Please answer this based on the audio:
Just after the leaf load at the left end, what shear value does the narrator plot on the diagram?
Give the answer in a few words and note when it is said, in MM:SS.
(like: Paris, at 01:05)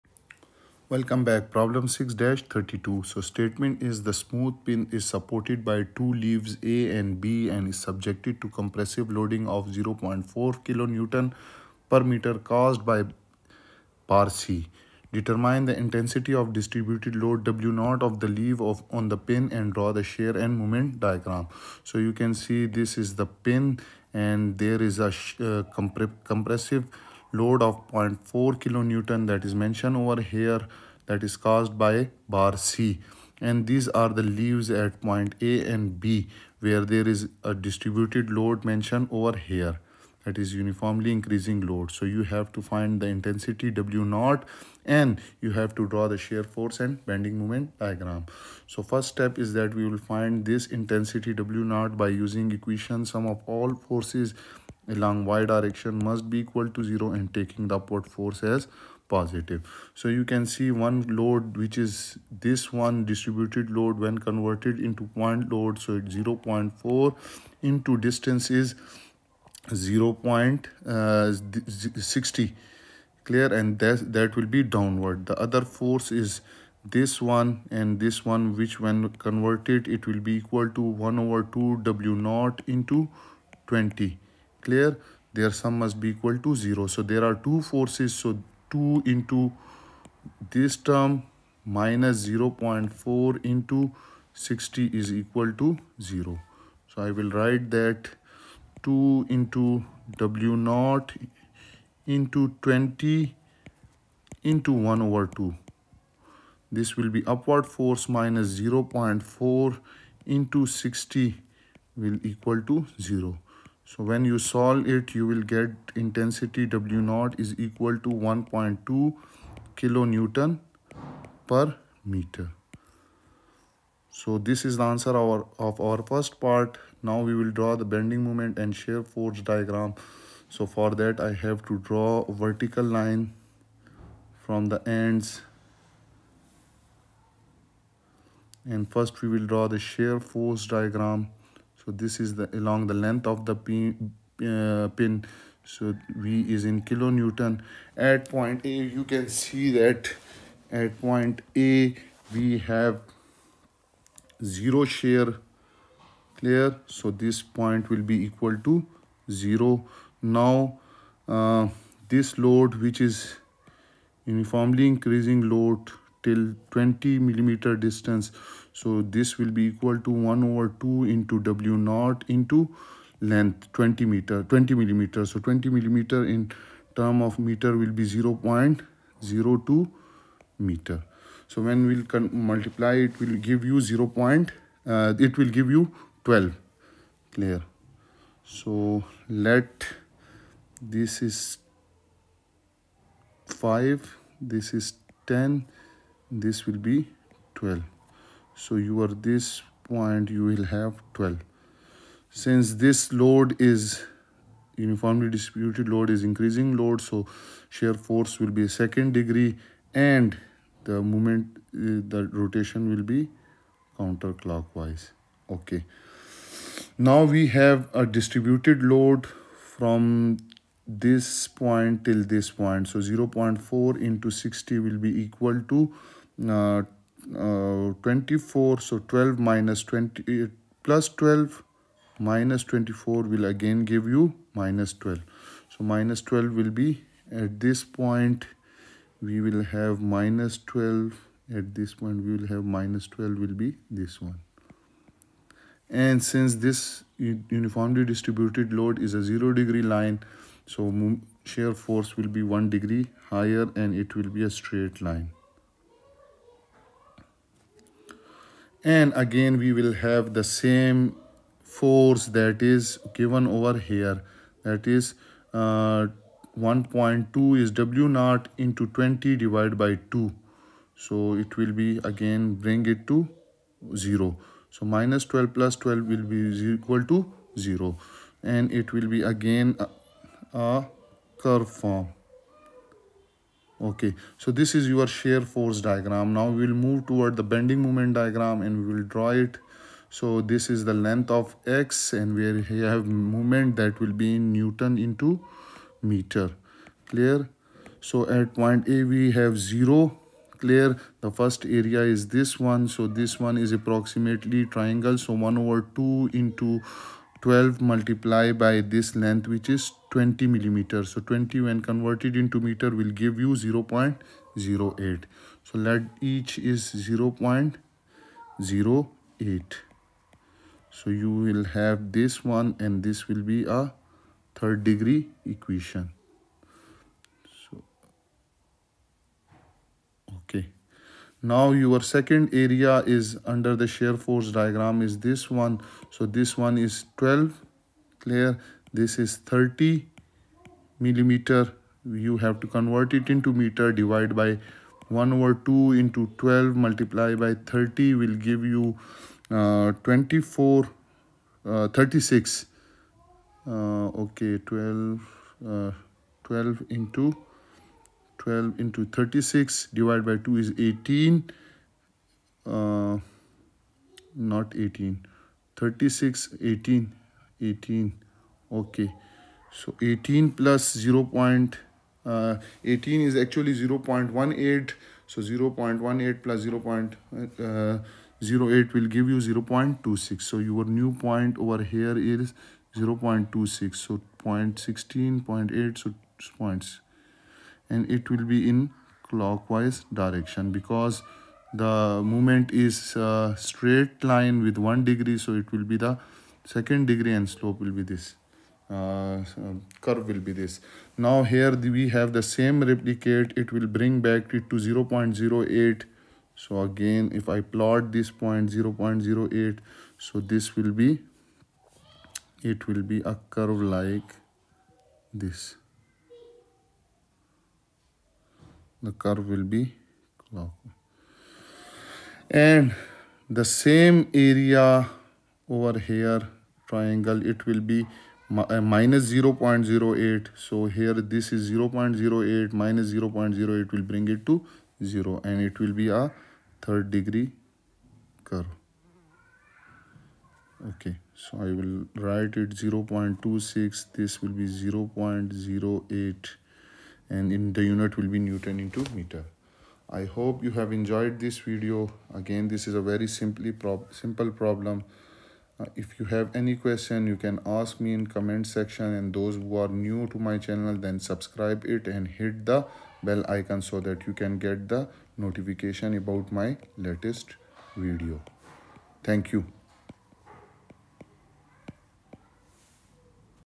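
12, at 03:05.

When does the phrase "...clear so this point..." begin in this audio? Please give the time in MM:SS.
02:36.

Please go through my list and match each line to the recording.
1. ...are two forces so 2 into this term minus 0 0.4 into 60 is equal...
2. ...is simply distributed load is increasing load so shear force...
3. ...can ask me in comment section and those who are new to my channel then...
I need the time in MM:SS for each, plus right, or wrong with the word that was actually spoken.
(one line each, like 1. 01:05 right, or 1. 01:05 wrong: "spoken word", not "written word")
1. 01:27 right
2. 03:23 wrong: "uniformly", not "simply"
3. 07:37 right.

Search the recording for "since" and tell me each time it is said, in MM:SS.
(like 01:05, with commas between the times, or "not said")
03:22, 04:06.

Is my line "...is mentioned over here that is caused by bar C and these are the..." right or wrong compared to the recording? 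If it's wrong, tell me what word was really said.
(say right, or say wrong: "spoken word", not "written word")
right.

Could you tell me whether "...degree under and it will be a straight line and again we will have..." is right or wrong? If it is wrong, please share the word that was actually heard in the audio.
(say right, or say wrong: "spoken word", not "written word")
wrong: "higher", not "under".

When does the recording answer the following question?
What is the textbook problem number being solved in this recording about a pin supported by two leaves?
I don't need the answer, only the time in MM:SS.
00:01.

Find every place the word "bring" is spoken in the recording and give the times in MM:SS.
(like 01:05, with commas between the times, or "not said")
04:32, 06:43, 07:14.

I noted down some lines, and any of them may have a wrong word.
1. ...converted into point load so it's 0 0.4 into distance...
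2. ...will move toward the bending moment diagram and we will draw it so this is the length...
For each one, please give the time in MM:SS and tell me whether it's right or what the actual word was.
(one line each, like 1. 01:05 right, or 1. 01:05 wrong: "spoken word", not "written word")
1. 01:04 right
2. 04:46 right.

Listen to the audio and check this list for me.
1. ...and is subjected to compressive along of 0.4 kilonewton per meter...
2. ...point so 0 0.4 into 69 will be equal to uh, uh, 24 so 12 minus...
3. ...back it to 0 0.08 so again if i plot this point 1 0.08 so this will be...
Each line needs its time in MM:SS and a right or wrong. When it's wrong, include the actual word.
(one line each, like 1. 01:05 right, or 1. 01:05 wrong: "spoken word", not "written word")
1. 00:07 wrong: "loading", not "along"
2. 03:42 wrong: "60", not "69"
3. 06:44 wrong: "0", not "1".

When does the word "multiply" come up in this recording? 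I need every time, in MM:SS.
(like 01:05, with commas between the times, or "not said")
03:02, 05:07, 05:46.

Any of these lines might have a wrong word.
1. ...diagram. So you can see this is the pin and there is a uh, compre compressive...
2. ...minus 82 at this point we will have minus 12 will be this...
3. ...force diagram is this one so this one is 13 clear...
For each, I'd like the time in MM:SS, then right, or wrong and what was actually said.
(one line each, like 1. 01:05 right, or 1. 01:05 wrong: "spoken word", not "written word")
1. 00:20 right
2. 04:00 wrong: "12", not "82"
3. 05:34 wrong: "12", not "13".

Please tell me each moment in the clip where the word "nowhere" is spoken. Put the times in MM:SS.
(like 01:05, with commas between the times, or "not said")
not said.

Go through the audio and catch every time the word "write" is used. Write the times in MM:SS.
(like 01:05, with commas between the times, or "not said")
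01:37, 07:22.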